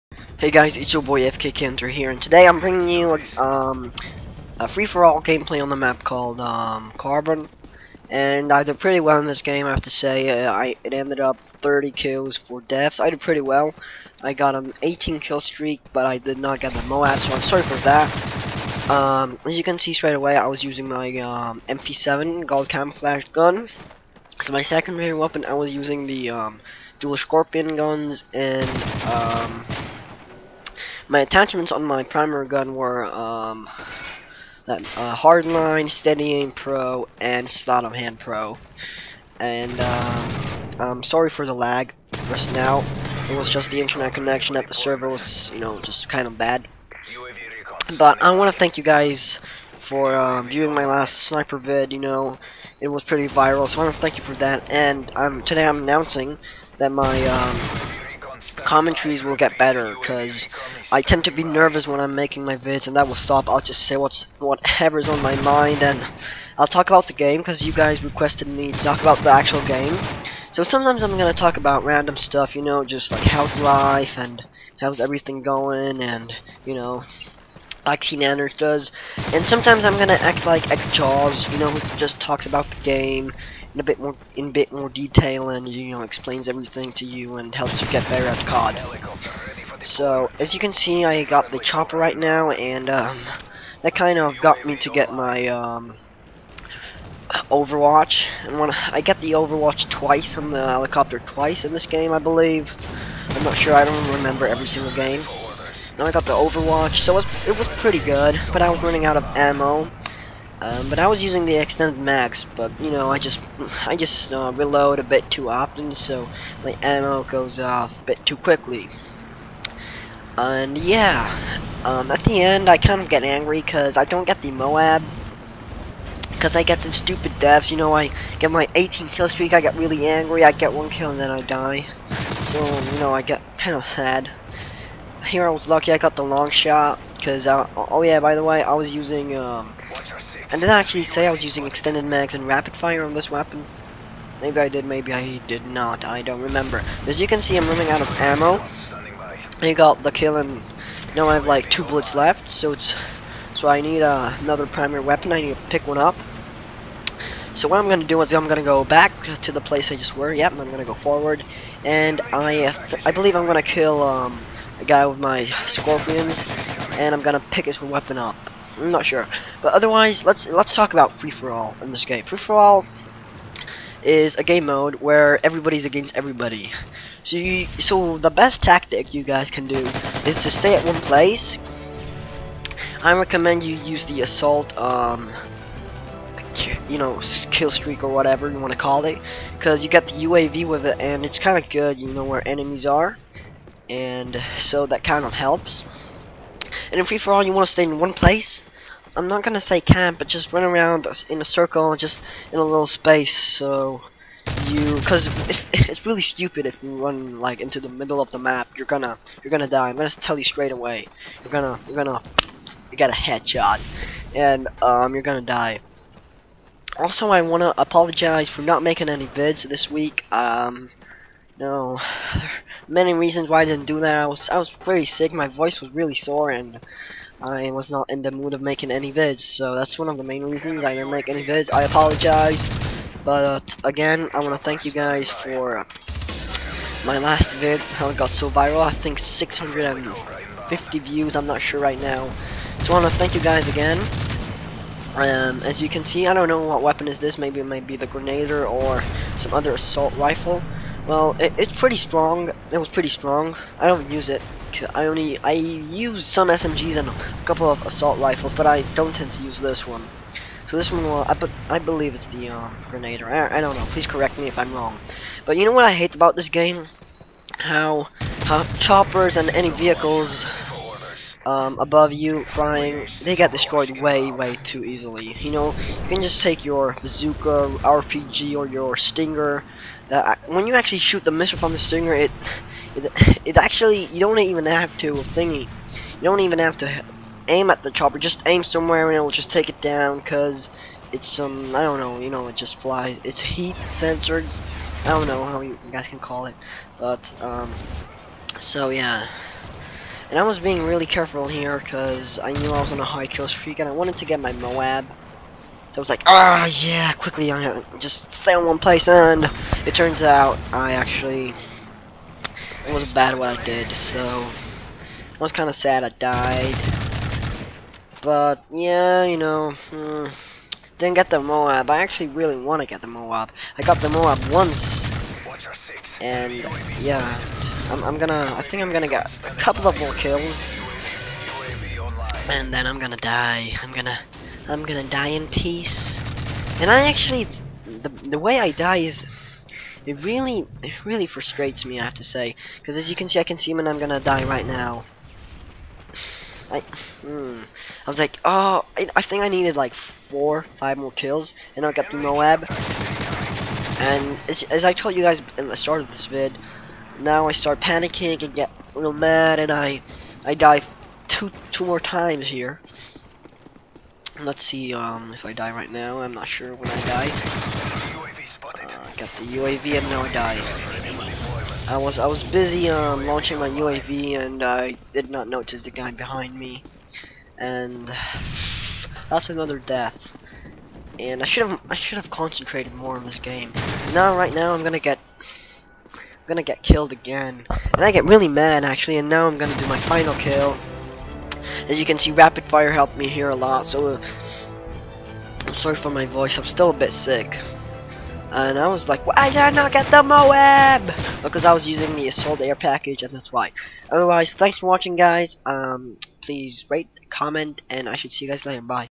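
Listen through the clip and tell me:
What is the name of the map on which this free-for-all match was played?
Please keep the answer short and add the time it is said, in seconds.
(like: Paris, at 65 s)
Carbon, at 6 s.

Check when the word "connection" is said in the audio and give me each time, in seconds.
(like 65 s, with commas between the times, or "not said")
44 s.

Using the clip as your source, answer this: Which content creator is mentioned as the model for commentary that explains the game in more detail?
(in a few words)
XJawz.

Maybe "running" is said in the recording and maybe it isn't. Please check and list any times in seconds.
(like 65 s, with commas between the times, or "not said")
108 s, 147 s.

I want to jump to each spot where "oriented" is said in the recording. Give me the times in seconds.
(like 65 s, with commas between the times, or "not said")
not said.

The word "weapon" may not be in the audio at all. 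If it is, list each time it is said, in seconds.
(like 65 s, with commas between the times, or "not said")
25 s, 143 s, 155 s, 167 s, 246 s.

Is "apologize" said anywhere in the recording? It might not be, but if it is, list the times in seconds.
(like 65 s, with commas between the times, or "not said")
217 s, 231 s.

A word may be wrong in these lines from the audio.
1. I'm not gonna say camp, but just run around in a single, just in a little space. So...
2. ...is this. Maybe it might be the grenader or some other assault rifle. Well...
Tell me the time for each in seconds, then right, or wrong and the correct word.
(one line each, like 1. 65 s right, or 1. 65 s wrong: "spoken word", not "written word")
1. 199 s wrong: "circle", not "single"
2. 247 s right.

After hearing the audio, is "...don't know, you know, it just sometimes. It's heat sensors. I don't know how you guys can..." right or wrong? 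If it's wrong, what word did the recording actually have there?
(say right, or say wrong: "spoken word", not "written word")
wrong: "flies", not "sometimes".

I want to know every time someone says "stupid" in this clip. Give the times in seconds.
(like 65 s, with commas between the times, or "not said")
126 s, 206 s.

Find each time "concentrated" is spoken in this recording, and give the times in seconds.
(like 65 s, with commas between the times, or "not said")
382 s.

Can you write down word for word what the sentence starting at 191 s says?
You know where enemies are and so that kind of helps.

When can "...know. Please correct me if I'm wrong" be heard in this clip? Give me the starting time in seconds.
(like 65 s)
263 s.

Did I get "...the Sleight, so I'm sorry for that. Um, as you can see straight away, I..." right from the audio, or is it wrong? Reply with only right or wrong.
wrong.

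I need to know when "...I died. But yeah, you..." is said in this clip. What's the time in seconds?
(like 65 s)
316 s.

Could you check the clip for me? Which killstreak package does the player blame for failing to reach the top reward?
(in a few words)
Assault Air package.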